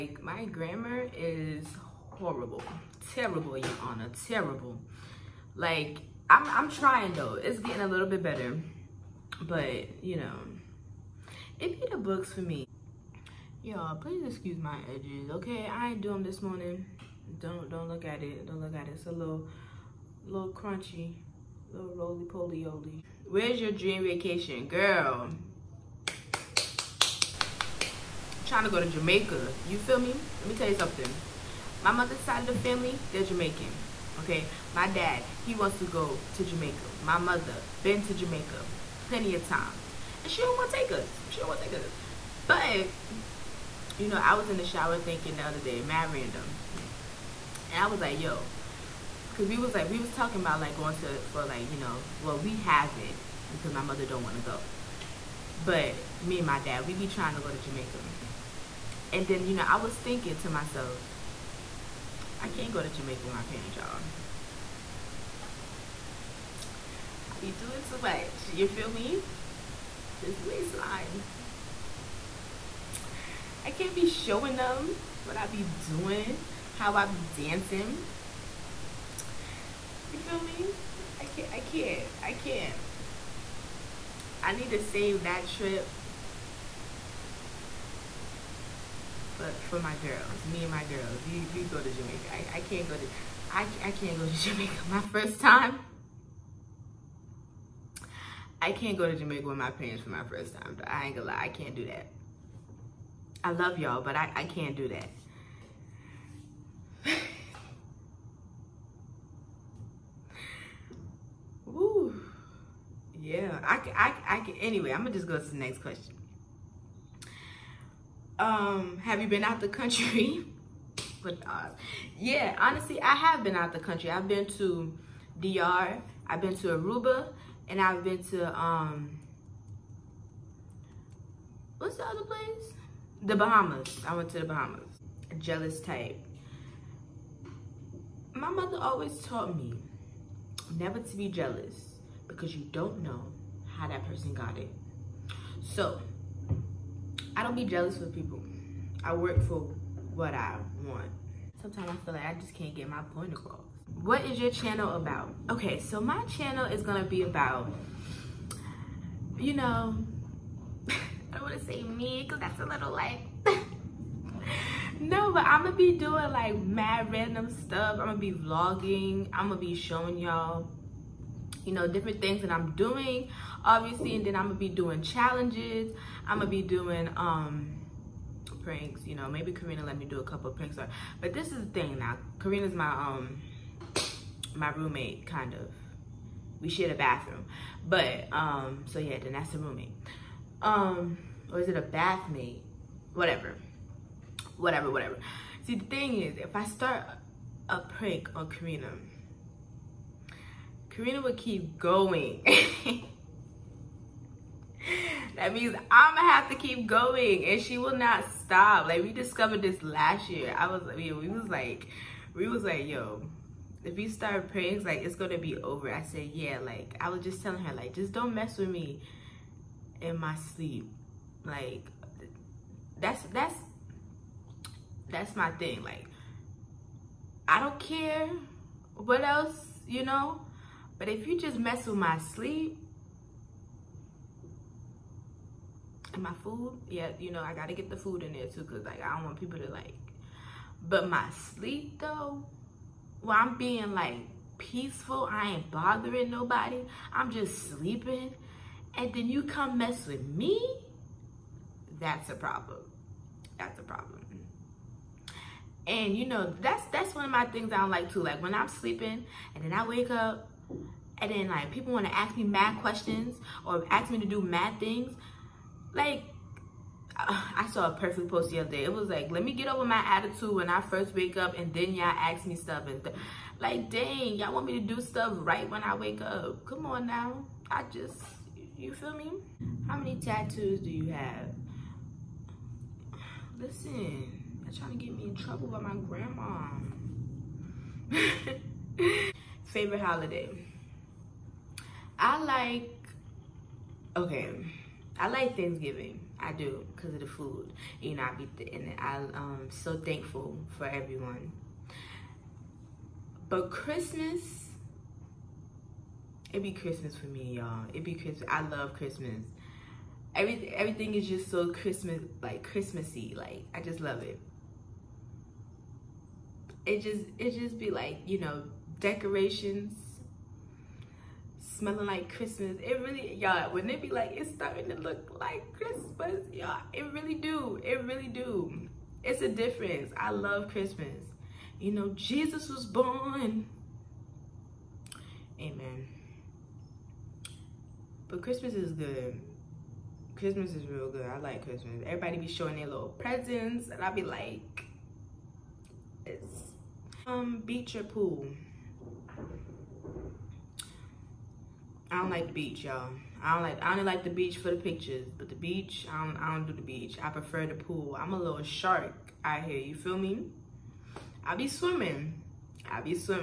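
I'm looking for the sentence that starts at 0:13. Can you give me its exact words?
Y'all, please excuse my edges, okay?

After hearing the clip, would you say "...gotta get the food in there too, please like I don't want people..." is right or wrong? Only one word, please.
wrong.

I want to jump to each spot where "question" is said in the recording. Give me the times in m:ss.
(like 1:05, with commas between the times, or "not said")
1:55, 4:22.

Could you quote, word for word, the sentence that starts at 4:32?
And th like, dang, y'all want me to do stuff right when I wake up.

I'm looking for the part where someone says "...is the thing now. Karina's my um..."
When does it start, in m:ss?
3:01.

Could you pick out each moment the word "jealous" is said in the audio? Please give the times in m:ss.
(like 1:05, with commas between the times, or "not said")
2:15, 2:21, 2:27.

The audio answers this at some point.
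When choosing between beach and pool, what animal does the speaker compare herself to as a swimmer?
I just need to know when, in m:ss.
5:58.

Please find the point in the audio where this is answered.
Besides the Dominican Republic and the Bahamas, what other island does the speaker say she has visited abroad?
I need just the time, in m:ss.
2:06.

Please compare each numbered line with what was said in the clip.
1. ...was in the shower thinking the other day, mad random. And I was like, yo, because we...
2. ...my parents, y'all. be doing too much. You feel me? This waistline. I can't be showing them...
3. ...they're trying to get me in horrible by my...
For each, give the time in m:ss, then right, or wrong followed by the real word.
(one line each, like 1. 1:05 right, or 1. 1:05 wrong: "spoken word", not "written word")
1. 0:44 right
2. 1:03 right
3. 4:44 wrong: "trouble", not "horrible".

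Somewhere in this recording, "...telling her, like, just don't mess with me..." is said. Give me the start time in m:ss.
3:37.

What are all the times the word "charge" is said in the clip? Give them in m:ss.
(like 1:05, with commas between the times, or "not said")
not said.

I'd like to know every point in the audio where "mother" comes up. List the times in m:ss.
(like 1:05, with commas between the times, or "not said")
0:31, 0:37, 0:53, 2:18.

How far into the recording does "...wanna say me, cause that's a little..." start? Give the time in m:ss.
2:41.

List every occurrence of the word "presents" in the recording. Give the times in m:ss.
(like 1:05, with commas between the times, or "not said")
5:43.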